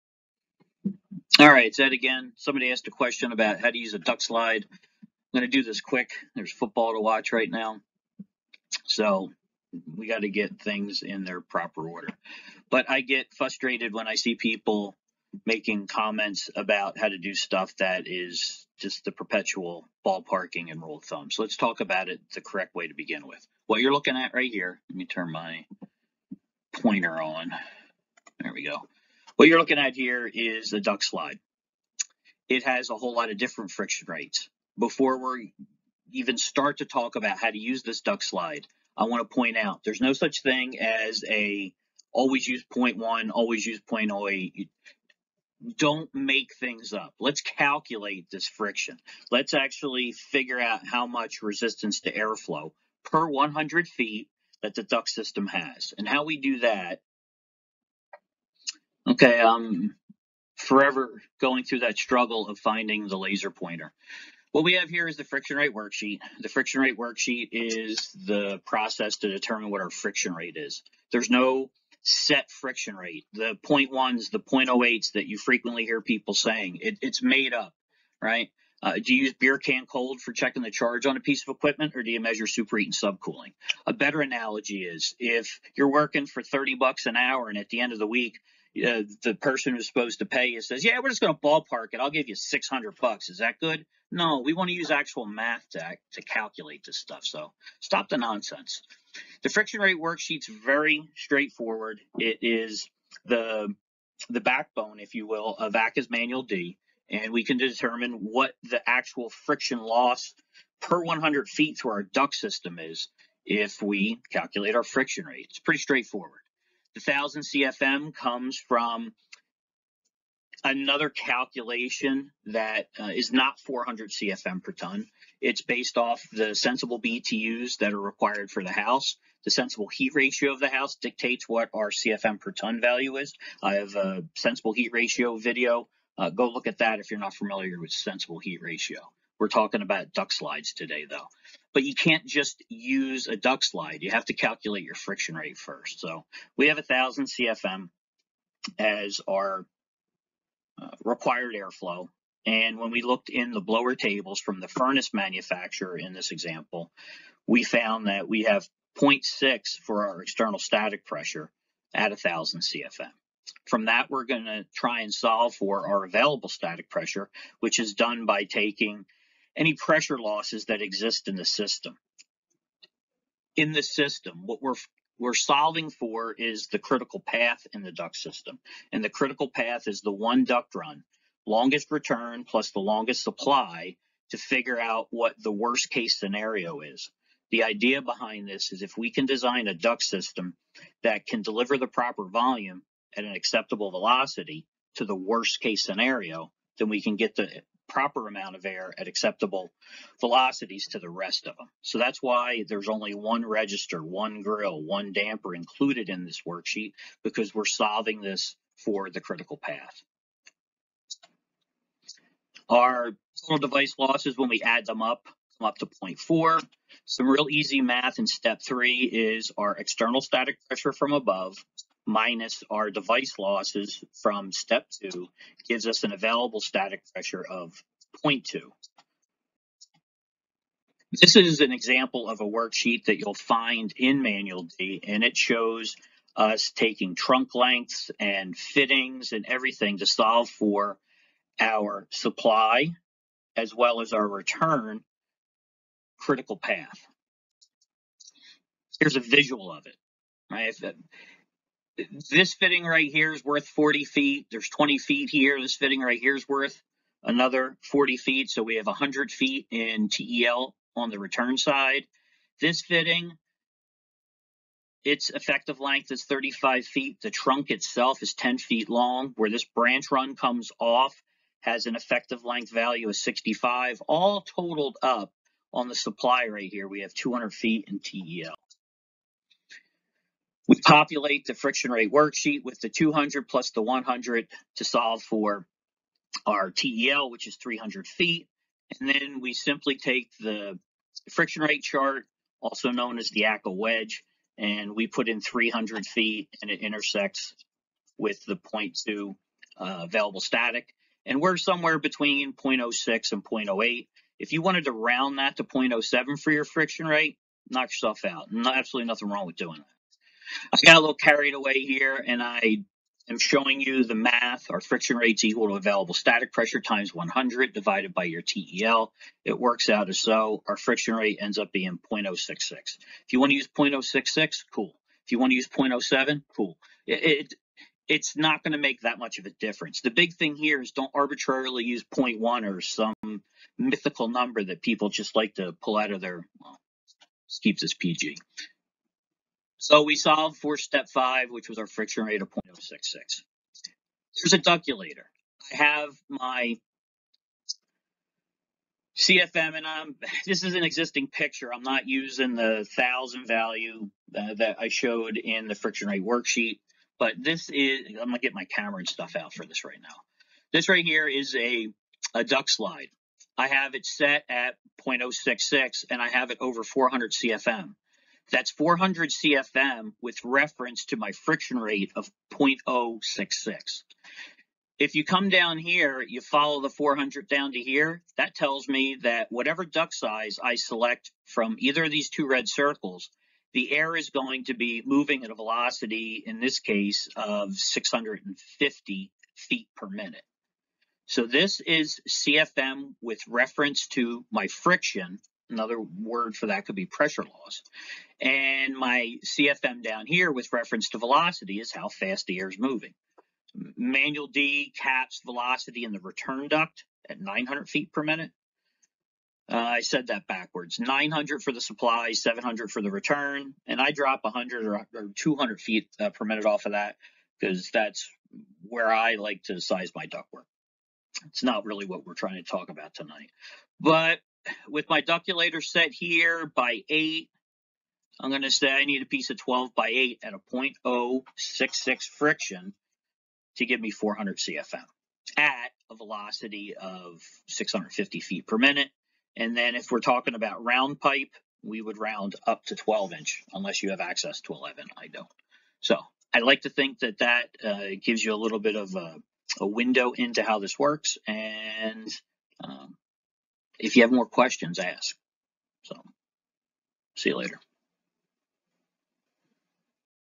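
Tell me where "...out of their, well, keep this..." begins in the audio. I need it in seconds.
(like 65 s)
335 s.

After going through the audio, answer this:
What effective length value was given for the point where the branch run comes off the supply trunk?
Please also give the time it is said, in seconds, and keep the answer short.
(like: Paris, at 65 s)
65, at 273 s.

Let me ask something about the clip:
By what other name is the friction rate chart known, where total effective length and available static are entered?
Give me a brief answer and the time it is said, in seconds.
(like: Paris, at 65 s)
ACCA wedge, at 293 s.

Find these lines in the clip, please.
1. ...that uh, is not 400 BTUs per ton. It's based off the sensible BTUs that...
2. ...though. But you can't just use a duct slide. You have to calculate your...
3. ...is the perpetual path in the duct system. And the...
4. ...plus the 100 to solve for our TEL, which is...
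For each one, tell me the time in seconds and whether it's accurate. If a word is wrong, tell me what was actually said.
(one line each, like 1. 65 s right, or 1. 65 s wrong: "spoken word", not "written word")
1. 122 s wrong: "CFM", not "BTUs"
2. 141 s right
3. 176 s wrong: "critical", not "perpetual"
4. 283 s right.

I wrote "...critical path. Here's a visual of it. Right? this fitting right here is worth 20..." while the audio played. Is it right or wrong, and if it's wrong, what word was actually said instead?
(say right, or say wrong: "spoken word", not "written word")
wrong: "40", not "20".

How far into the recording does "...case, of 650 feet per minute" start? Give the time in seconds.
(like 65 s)
386 s.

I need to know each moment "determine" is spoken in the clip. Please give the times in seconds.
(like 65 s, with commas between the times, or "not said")
69 s, 107 s.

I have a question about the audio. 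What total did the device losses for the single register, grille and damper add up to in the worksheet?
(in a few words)
0.4.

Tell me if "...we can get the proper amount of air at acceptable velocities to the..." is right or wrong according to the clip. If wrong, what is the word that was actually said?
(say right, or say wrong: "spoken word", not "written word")
right.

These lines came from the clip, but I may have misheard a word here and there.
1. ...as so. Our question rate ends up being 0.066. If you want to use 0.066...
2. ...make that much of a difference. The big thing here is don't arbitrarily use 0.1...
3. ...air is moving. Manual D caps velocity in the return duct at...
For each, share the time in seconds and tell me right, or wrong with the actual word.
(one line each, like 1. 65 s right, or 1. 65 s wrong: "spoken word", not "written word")
1. 320 s wrong: "friction", not "question"
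2. 328 s right
3. 402 s right.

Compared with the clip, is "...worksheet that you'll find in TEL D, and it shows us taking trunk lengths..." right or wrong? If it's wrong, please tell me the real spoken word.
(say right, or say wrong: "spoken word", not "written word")
wrong: "Manual", not "TEL".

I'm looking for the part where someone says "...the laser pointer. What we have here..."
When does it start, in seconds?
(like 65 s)
63 s.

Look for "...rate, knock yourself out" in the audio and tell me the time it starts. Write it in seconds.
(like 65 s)
307 s.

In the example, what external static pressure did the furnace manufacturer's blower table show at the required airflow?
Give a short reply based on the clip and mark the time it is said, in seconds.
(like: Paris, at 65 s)
0.6, at 158 s.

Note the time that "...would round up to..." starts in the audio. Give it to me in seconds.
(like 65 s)
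442 s.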